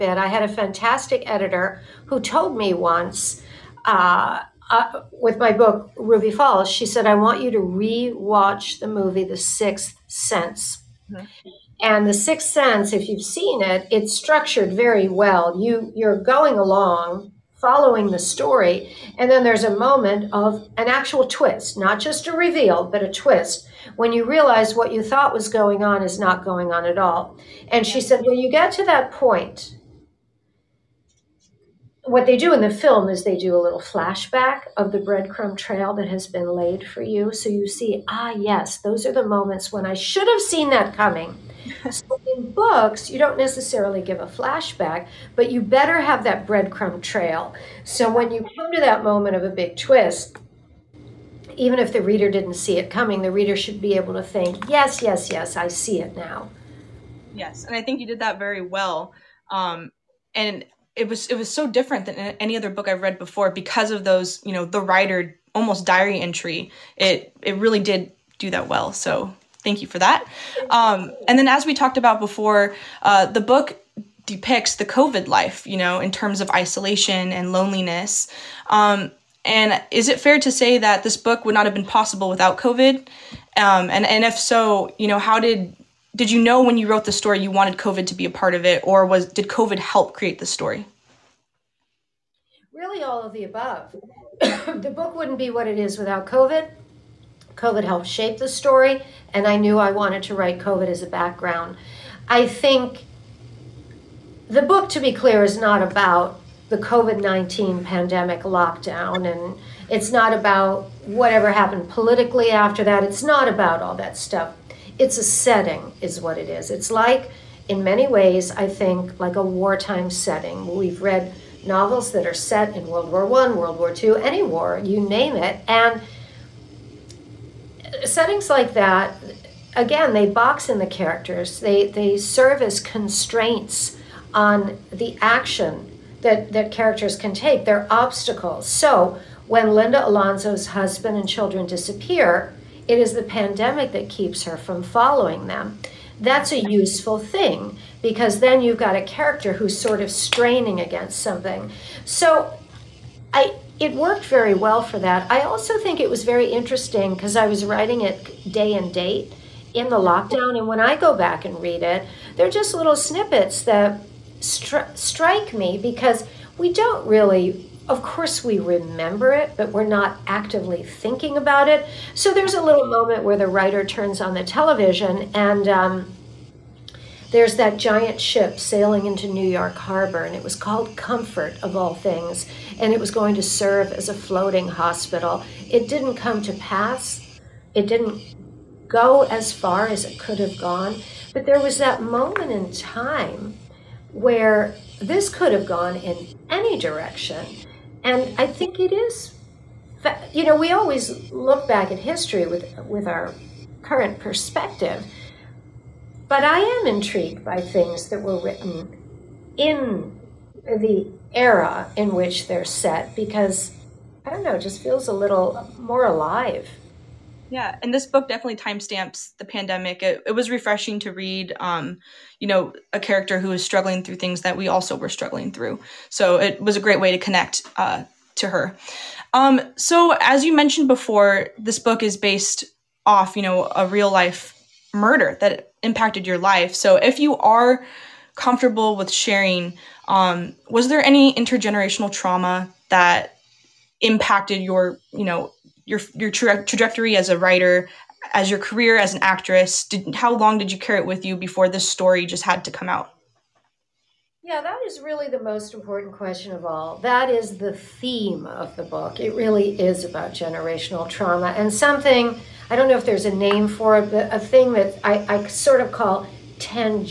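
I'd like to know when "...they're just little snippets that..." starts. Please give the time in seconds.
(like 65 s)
162 s.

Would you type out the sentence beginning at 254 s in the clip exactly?
Yeah, that is really the most important question of all.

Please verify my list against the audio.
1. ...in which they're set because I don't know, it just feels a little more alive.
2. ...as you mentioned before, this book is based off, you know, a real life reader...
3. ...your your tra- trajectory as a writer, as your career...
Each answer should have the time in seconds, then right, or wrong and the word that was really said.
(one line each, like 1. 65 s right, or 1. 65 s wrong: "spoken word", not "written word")
1. 211 s right
2. 230 s wrong: "murder", not "reader"
3. 245 s right.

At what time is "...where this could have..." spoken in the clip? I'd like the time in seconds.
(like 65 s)
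194 s.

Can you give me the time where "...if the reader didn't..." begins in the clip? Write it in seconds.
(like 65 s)
51 s.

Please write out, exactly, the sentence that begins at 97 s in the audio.
COVID helped shape the story, and I knew I wanted to write COVID as a background.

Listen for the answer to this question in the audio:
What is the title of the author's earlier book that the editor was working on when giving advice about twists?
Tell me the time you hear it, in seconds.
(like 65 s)
5 s.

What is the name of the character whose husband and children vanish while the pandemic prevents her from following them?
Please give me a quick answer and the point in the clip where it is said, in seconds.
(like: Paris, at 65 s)
Linda Alonso, at 139 s.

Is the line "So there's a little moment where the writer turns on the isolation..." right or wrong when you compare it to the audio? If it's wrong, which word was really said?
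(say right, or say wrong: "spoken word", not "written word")
wrong: "television", not "isolation".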